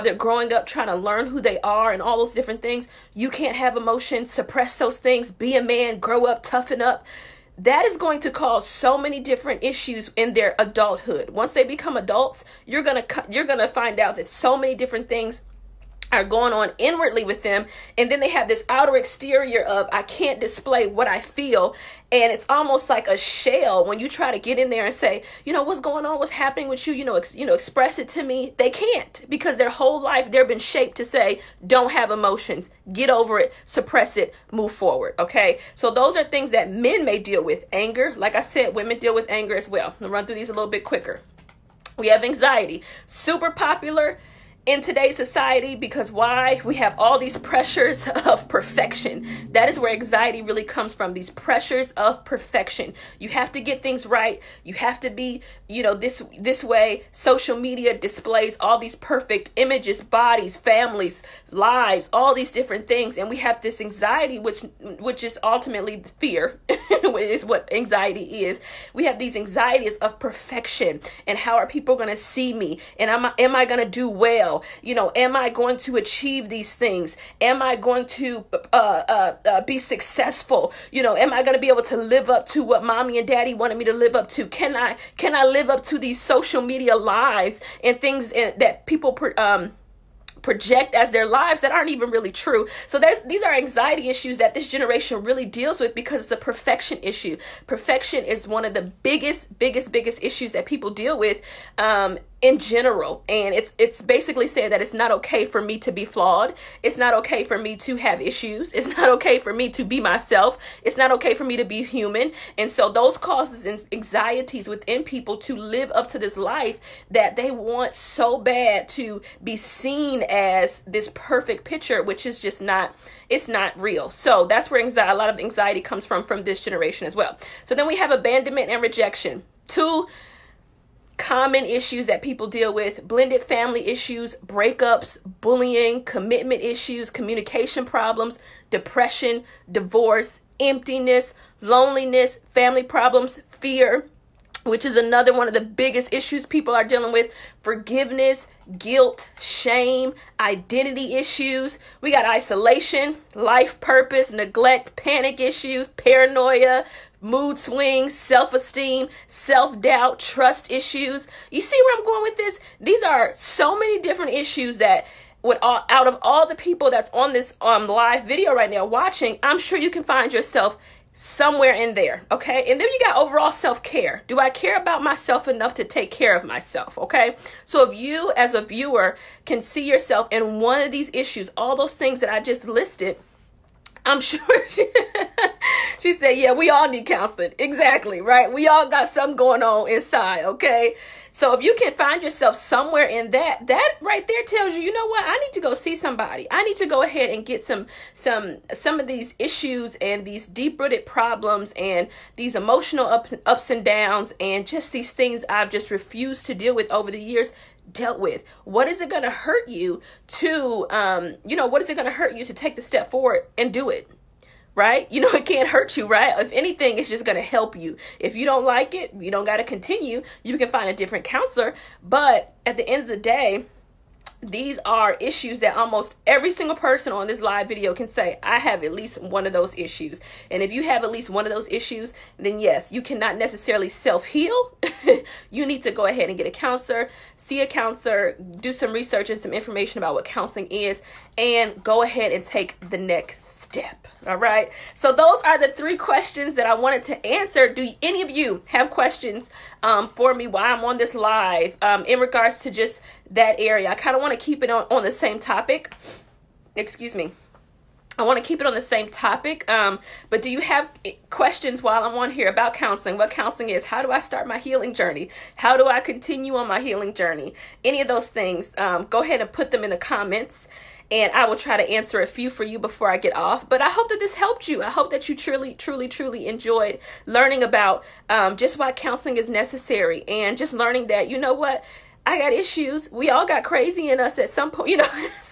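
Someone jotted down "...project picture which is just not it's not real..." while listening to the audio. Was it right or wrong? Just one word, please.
wrong.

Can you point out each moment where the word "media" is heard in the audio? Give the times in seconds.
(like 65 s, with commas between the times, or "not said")
57 s, 86 s.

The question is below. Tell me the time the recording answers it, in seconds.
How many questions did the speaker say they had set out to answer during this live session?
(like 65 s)
245 s.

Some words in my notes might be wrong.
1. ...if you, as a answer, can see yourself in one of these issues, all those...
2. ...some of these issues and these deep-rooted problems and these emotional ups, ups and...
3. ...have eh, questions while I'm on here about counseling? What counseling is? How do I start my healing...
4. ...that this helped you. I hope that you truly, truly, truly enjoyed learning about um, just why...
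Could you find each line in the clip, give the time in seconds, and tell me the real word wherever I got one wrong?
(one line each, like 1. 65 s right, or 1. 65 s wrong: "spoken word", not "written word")
1. 177 s wrong: "viewer", not "answer"
2. 198 s right
3. 260 s right
4. 274 s right.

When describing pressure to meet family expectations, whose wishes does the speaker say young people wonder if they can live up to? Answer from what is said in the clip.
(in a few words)
mommy and daddy.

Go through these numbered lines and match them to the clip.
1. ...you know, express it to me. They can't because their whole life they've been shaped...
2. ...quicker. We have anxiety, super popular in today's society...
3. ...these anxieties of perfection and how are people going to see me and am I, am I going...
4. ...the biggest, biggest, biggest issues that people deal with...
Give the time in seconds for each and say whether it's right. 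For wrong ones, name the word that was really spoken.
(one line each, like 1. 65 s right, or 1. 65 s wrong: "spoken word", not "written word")
1. 27 s right
2. 40 s right
3. 69 s right
4. 98 s right.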